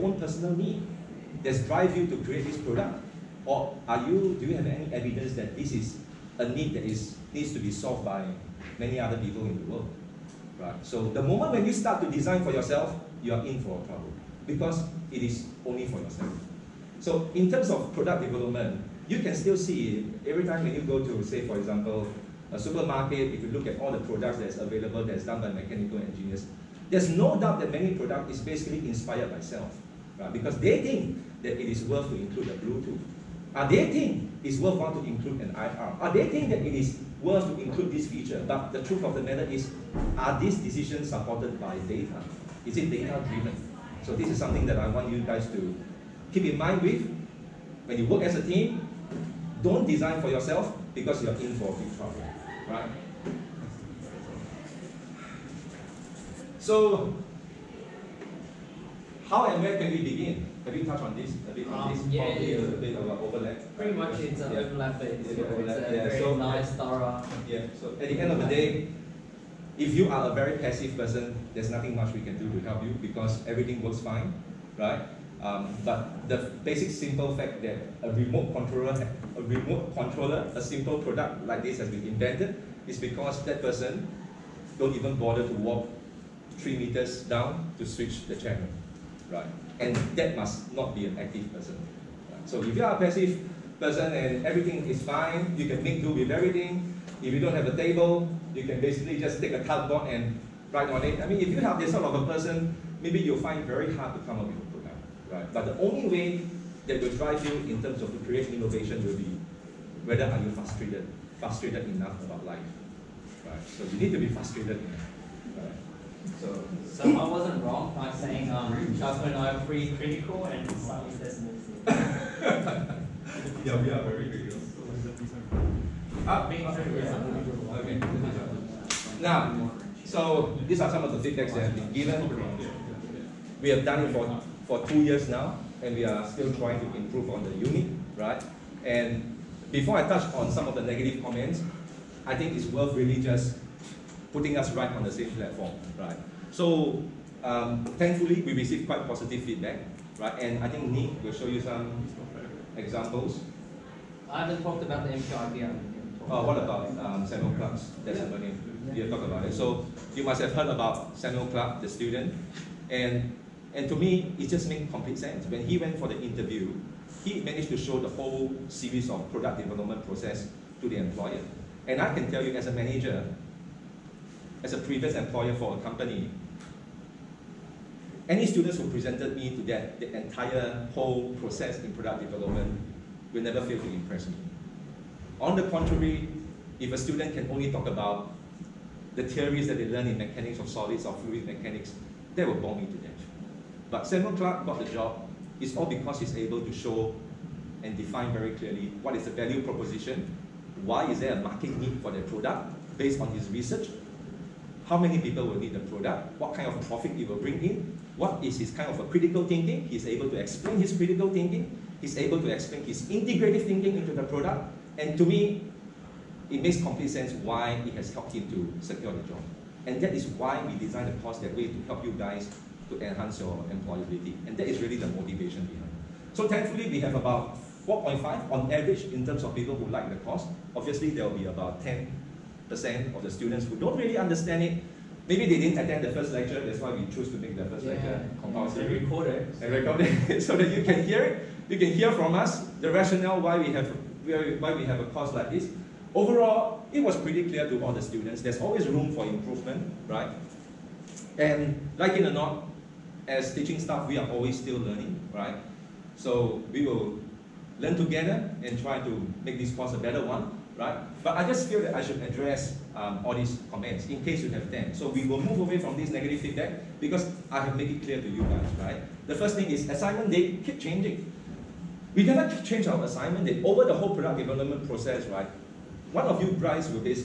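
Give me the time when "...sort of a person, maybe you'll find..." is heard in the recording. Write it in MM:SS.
01:41.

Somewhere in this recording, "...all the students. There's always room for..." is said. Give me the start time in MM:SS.
04:07.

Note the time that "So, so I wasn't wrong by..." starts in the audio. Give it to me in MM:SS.
01:56.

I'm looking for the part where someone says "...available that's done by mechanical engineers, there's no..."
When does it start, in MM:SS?
00:24.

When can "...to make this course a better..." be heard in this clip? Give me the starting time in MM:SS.
04:18.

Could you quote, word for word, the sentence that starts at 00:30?
because they think that it is worth to include a Bluetooth.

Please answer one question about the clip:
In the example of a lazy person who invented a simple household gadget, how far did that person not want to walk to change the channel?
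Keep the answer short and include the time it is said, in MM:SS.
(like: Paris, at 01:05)
3 meters, at 01:26.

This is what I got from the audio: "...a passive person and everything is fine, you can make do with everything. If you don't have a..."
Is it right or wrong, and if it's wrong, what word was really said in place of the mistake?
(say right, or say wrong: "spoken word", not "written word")
right.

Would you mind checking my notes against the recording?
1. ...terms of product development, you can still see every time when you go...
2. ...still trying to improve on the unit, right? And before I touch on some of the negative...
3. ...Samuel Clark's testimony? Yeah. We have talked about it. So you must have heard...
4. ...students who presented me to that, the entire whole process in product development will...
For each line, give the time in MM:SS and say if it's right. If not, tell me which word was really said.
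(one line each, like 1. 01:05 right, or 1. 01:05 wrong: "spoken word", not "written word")
1. 00:17 right
2. 02:16 right
3. 02:37 right
4. 02:58 right.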